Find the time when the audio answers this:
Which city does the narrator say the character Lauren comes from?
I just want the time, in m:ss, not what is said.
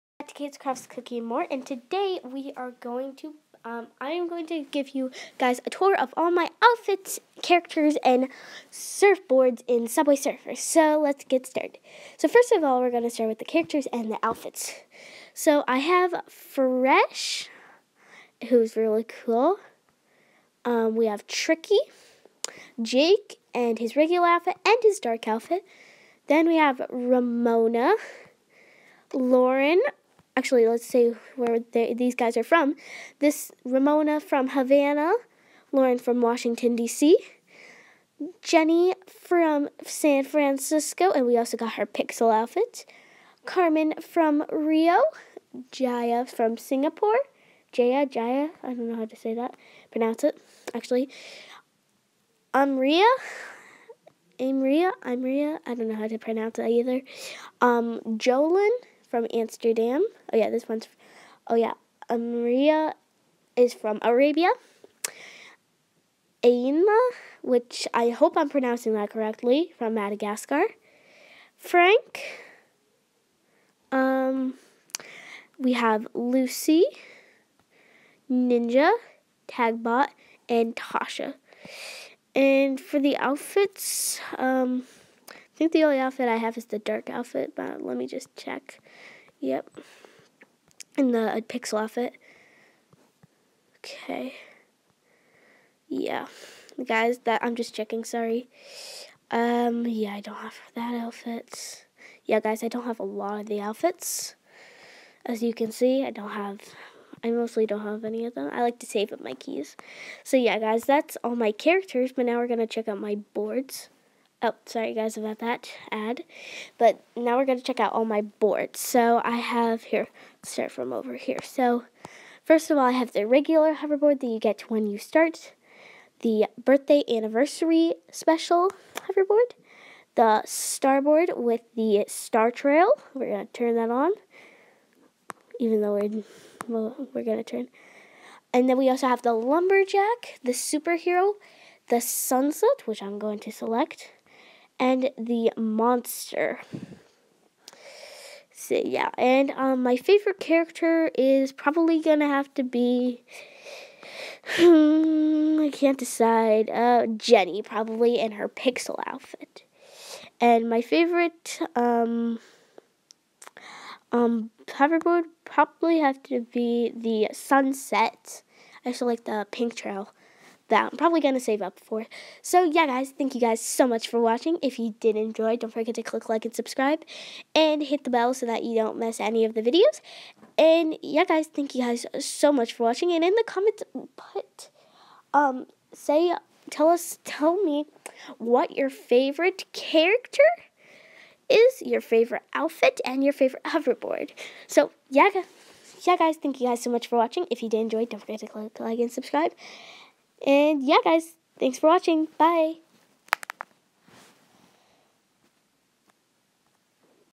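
0:36.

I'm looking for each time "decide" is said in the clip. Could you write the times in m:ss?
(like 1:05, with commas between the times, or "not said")
2:35.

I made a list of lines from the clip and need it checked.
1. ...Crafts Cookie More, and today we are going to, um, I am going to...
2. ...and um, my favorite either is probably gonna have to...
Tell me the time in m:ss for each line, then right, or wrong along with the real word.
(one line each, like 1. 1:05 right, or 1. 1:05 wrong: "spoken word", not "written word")
1. 0:00 right
2. 2:29 wrong: "character", not "either".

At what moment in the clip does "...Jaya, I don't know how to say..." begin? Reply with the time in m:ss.
0:48.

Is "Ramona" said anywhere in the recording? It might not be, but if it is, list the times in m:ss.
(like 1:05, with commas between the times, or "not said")
0:26, 0:33.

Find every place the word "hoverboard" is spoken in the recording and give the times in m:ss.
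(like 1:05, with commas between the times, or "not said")
2:03, 2:09, 2:44, 3:13.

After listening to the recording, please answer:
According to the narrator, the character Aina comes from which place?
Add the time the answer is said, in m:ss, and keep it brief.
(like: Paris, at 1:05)
Madagascar, at 1:09.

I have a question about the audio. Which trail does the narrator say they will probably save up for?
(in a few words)
The pink trail.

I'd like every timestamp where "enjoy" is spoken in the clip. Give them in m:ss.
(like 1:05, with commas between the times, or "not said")
2:55, 3:17.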